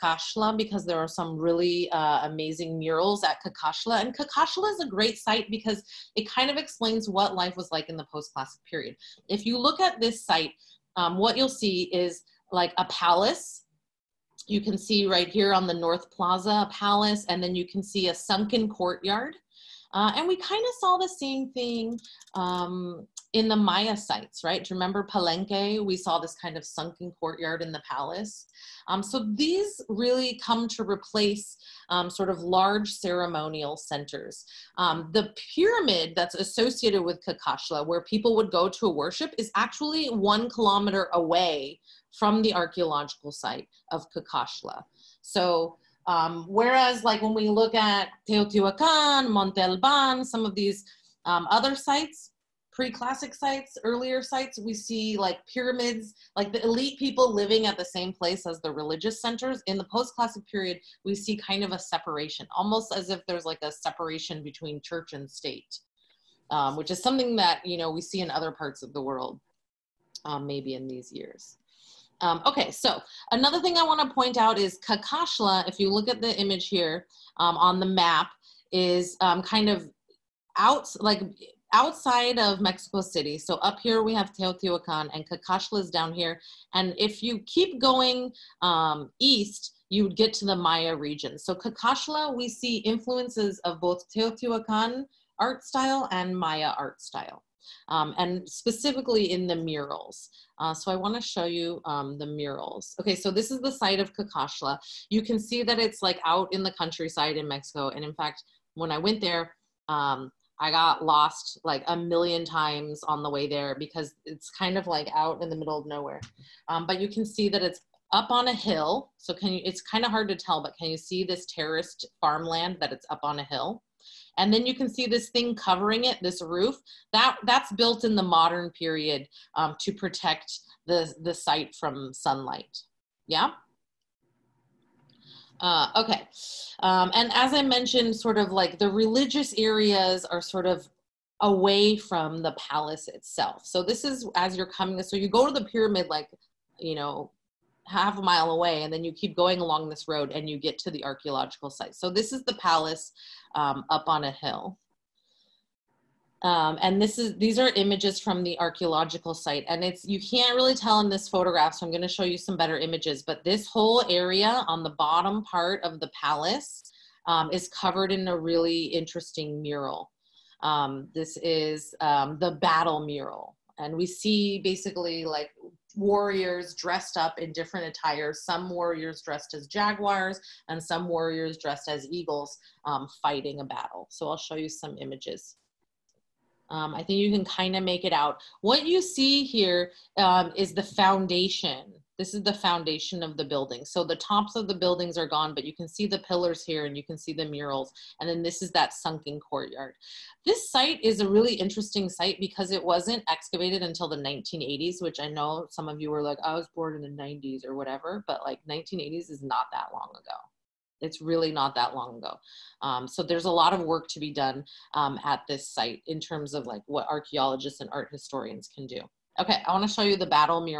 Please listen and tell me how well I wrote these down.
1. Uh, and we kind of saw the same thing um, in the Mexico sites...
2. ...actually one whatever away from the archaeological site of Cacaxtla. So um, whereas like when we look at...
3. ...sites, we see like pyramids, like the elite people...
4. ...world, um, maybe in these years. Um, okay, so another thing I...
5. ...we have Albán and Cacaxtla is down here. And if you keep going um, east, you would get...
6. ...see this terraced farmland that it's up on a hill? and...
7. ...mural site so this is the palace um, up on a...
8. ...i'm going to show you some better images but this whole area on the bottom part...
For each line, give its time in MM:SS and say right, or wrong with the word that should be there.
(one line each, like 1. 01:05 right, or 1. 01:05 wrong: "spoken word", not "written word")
1. 00:19 wrong: "Maya", not "Mexico"
2. 00:39 wrong: "kilometer", not "whatever"
3. 00:54 right
4. 01:09 right
5. 01:24 wrong: "Teotihuacan", not "Albán"
6. 02:00 right
7. 02:31 wrong: "archaeological", not "mural"
8. 02:41 right.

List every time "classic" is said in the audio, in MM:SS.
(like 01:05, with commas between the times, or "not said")
00:08, 00:52, 00:59.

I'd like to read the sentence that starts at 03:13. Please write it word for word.
So the tops of the buildings are gone, but you can see the pillars here and you can see the murals.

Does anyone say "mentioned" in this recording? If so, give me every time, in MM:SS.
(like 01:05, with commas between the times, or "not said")
02:17.